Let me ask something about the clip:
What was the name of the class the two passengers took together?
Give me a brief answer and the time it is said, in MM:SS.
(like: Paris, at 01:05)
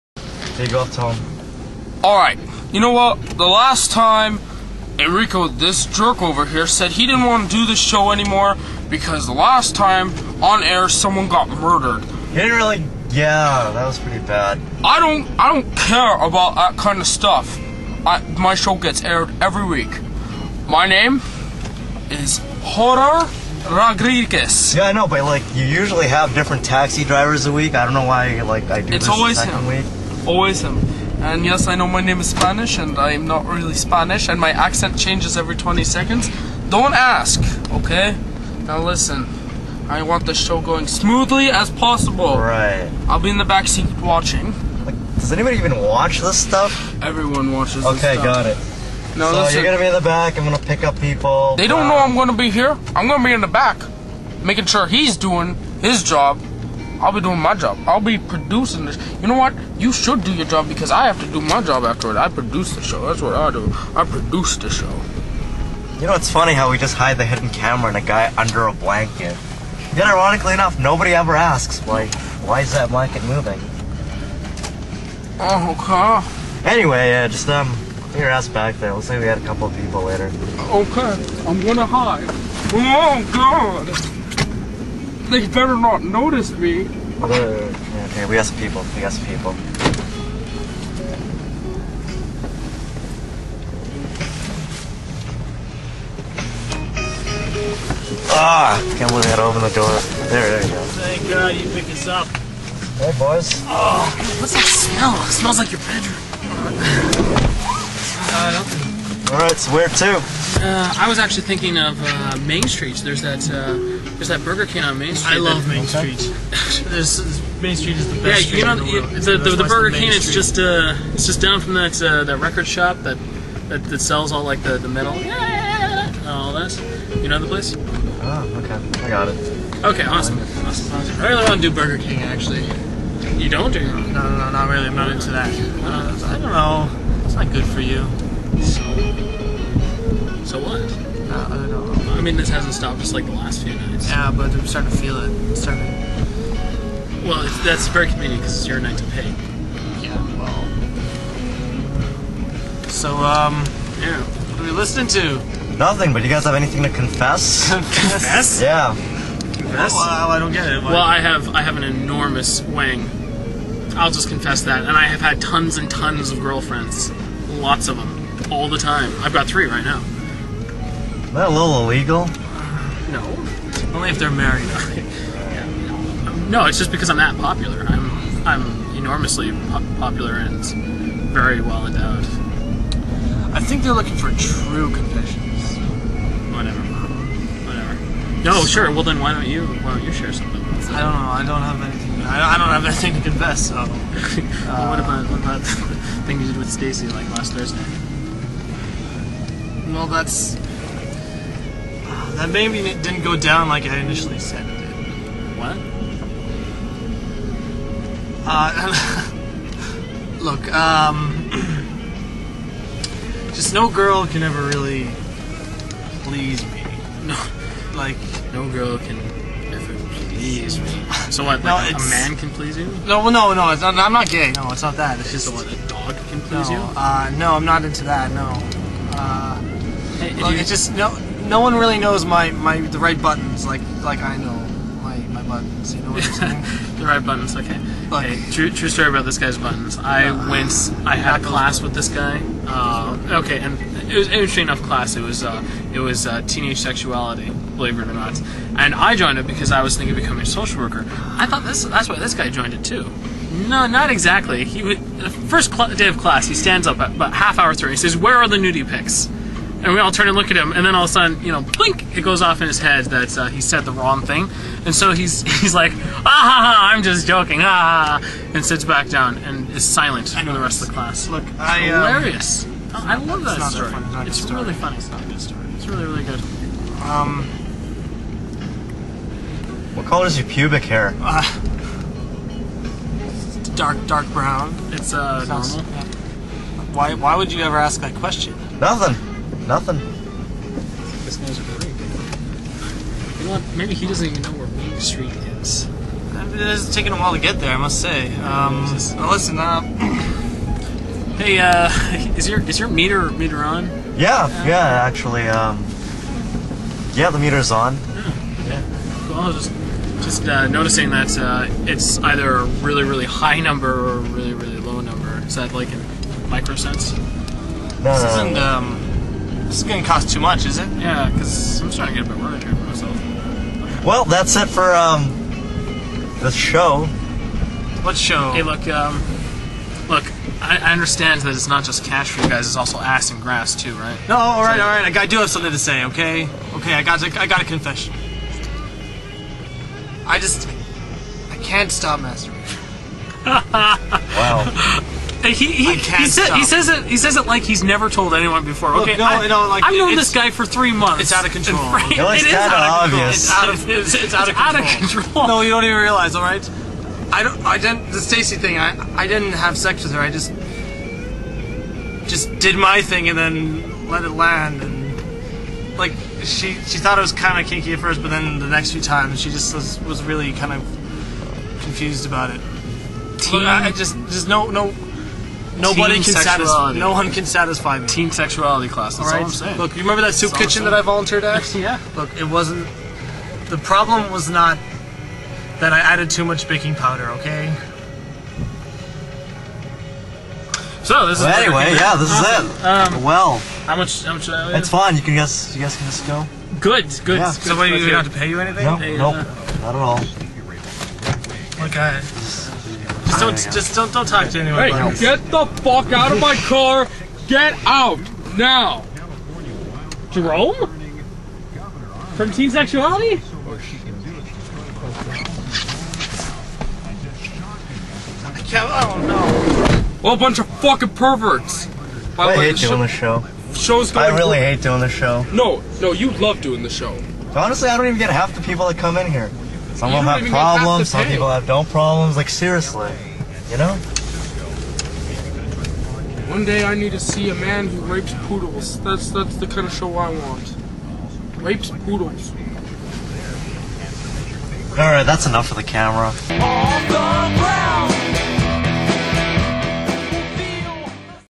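Teenage sexuality, at 04:06.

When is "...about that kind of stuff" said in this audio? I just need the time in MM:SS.
00:16.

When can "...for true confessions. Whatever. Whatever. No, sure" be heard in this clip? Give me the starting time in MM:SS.
03:04.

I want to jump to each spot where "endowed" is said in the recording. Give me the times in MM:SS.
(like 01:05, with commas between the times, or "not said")
03:01.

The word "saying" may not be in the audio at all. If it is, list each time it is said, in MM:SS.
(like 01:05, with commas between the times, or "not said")
03:56, 06:19.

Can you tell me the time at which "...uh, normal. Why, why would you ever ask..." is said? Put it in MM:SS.
04:45.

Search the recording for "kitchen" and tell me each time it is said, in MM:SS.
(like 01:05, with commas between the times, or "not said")
06:20.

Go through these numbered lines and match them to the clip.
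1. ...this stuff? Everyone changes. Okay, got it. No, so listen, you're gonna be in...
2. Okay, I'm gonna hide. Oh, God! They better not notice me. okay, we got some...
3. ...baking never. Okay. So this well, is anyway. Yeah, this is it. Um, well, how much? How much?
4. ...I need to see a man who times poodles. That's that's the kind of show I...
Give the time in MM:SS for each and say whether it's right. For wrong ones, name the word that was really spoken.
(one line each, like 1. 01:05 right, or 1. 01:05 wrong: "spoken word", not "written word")
1. 00:46 wrong: "watches", not "changes"
2. 01:20 right
3. 06:26 wrong: "powder", not "never"
4. 07:16 wrong: "rapes", not "times".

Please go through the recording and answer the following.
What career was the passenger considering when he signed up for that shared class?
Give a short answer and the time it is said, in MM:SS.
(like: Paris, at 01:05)
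Social worker, at 04:10.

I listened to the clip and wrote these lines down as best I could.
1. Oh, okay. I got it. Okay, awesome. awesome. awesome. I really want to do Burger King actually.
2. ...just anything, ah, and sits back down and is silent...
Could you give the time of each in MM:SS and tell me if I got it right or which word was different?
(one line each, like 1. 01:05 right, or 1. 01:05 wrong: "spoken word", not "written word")
1. 02:07 right
2. 04:27 wrong: "joking", not "anything".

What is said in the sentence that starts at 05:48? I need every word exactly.
Look, okay, no, I, no, like, I've known this guy for three months.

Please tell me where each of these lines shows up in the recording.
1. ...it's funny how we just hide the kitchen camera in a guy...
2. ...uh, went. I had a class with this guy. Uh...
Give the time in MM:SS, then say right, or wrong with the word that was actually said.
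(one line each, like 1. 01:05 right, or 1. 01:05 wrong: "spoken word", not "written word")
1. 01:06 wrong: "hidden", not "kitchen"
2. 04:00 right.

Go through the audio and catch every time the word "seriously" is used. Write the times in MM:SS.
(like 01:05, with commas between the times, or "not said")
07:12.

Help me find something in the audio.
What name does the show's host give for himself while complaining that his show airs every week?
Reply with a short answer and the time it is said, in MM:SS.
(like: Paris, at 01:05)
Hor-er Rodriguez, at 00:22.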